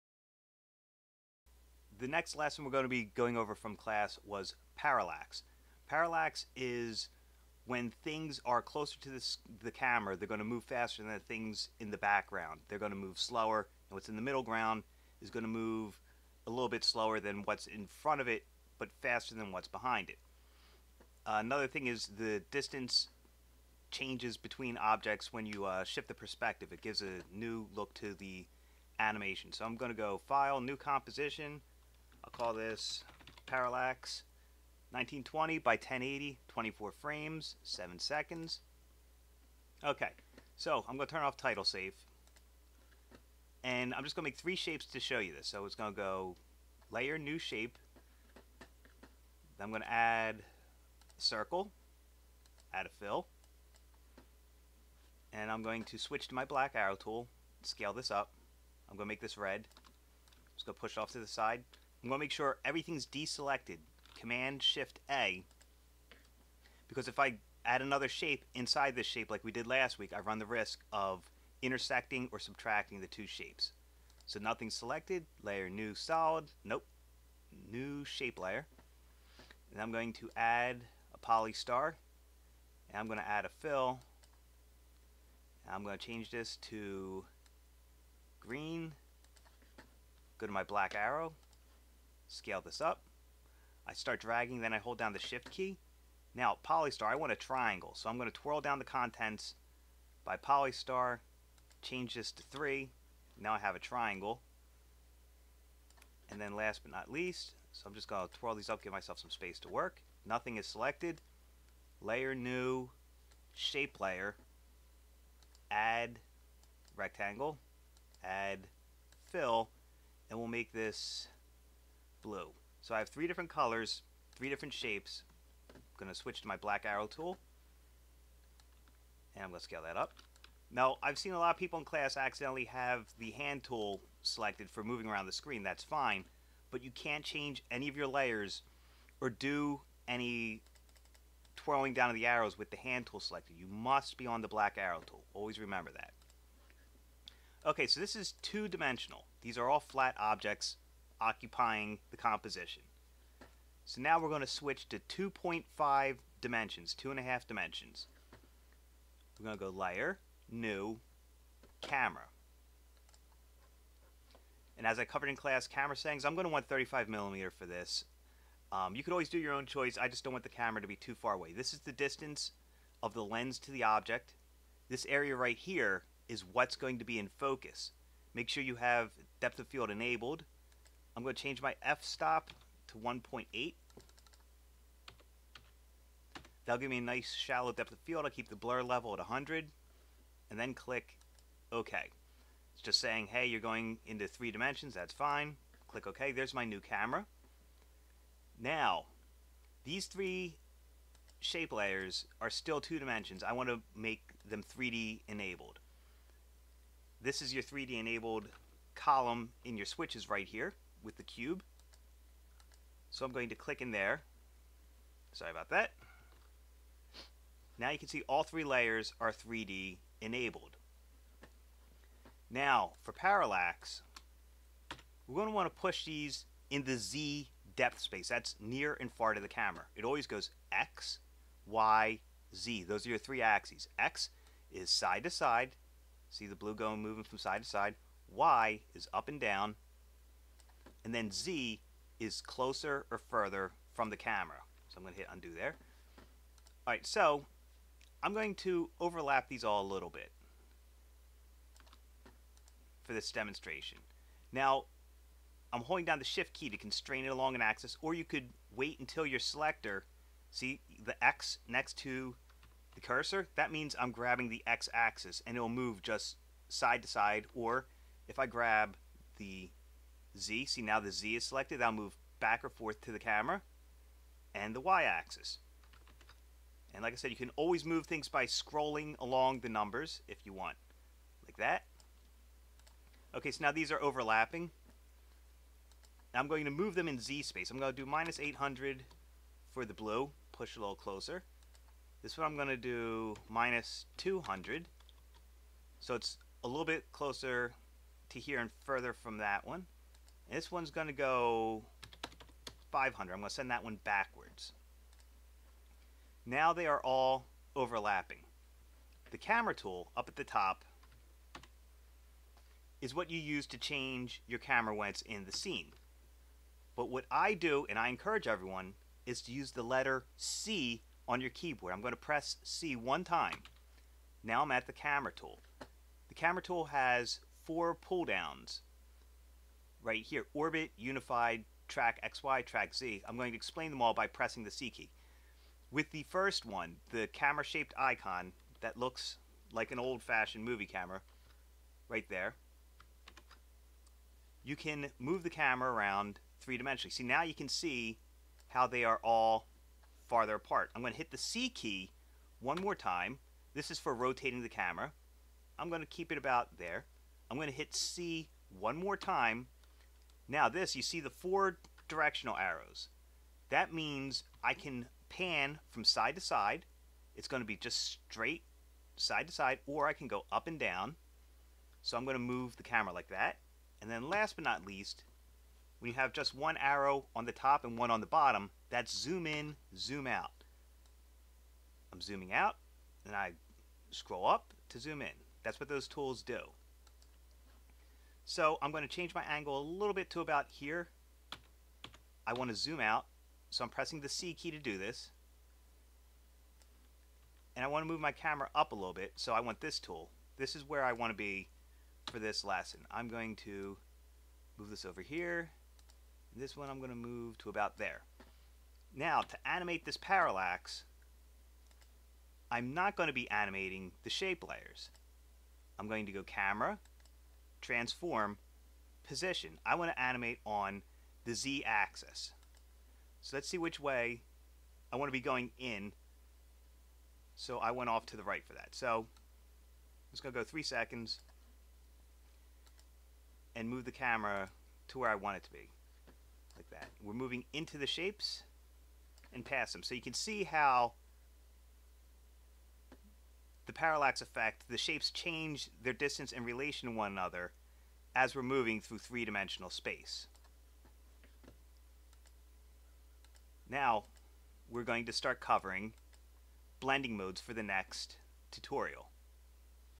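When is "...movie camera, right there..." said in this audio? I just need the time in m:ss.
5:40.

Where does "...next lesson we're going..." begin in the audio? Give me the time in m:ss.
0:02.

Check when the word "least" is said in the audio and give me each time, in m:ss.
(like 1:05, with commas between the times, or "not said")
1:47, 6:14.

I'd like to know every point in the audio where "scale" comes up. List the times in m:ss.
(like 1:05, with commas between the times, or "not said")
0:57, 1:32, 2:09.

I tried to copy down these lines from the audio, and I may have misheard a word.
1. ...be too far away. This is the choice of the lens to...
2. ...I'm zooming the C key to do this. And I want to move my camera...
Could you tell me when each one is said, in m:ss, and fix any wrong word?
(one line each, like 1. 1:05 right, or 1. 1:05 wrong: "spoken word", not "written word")
1. 2:50 wrong: "distance", not "choice"
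2. 6:33 wrong: "pressing", not "zooming".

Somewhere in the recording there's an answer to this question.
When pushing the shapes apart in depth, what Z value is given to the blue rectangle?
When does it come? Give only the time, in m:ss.
4:48.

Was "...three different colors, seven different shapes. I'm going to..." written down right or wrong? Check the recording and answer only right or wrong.
wrong.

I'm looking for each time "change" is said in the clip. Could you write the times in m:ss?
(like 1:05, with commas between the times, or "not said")
0:23, 1:26, 1:41, 2:17, 3:01, 5:13, 6:29, 7:25.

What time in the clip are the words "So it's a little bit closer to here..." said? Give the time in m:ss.
4:56.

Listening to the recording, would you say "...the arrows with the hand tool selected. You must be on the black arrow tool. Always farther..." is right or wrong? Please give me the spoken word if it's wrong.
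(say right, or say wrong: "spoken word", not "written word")
wrong: "remember", not "farther".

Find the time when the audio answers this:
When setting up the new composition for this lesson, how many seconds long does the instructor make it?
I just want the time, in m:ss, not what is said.
0:37.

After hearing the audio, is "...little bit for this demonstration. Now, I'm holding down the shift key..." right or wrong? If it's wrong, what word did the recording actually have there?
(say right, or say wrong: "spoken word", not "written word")
right.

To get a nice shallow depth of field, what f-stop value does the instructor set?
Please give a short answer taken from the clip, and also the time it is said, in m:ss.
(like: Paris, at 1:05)
1.8, at 3:02.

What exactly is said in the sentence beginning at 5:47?
See, now you can see how they are all farther apart.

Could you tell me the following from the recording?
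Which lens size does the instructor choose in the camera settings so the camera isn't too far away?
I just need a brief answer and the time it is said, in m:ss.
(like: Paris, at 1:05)
35 millimeter, at 2:46.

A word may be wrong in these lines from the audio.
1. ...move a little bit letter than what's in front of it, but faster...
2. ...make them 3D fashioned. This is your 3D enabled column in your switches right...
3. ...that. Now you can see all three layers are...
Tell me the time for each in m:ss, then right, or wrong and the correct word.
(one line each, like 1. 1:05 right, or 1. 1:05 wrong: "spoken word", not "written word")
1. 0:15 wrong: "slower", not "letter"
2. 3:23 wrong: "enabled", not "fashioned"
3. 3:35 right.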